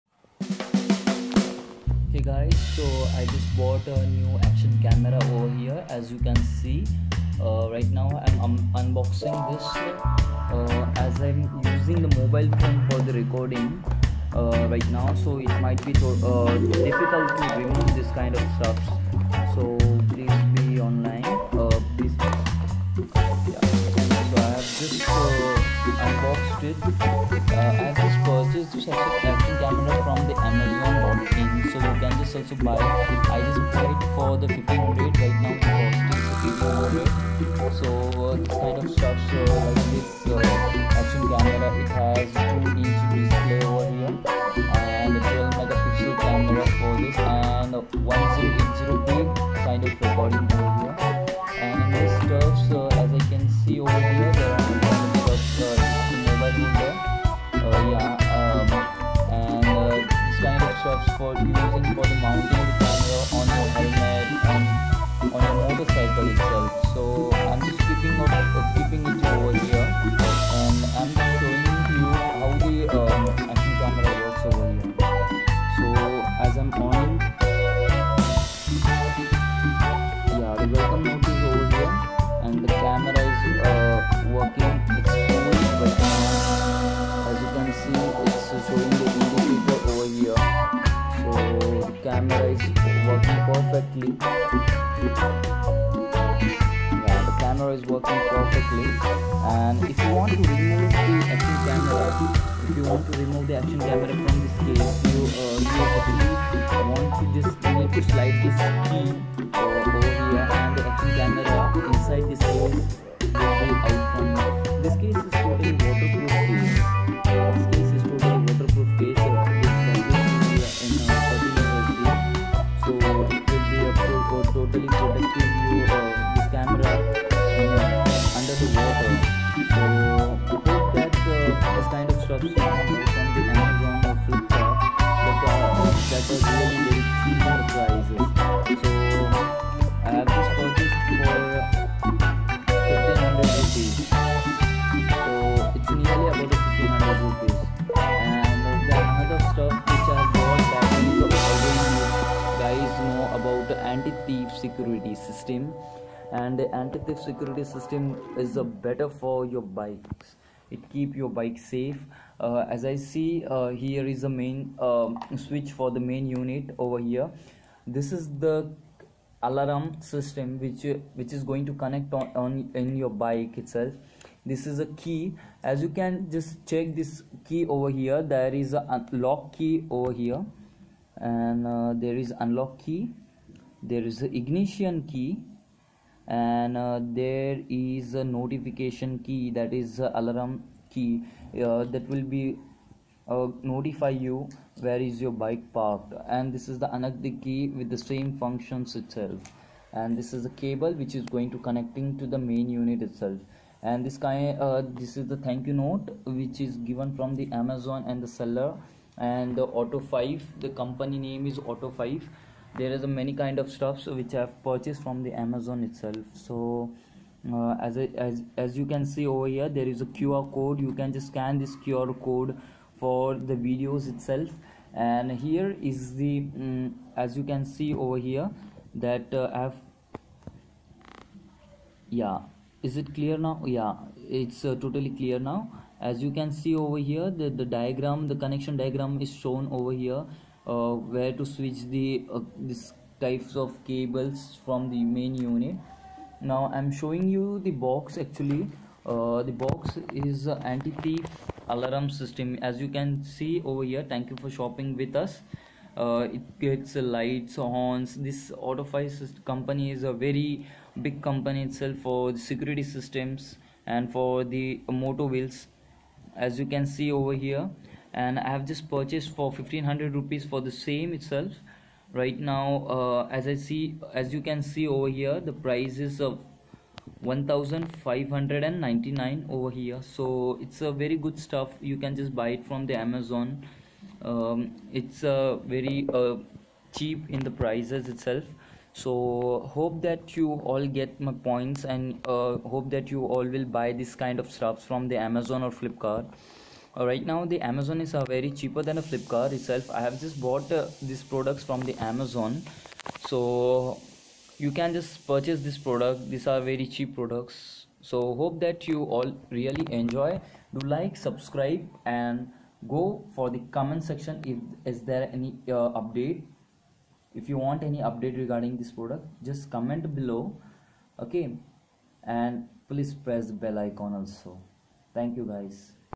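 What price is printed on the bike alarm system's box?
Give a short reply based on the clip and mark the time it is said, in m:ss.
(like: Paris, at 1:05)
1599, at 4:37.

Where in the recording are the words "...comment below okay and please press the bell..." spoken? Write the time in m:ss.
5:19.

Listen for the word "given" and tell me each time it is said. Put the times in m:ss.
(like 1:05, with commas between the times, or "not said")
3:26.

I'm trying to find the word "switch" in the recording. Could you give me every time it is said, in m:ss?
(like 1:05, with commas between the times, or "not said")
2:45, 4:01.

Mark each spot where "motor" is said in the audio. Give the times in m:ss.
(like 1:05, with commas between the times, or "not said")
4:24.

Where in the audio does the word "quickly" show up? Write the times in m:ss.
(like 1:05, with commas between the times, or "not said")
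not said.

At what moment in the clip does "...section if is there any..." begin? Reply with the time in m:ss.
5:14.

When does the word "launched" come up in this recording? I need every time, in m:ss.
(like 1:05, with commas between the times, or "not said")
not said.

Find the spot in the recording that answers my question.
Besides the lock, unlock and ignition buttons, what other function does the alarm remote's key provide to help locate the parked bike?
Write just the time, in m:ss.
3:08.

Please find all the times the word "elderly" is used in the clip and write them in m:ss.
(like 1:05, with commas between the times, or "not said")
not said.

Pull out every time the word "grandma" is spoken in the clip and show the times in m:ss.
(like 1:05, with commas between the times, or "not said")
not said.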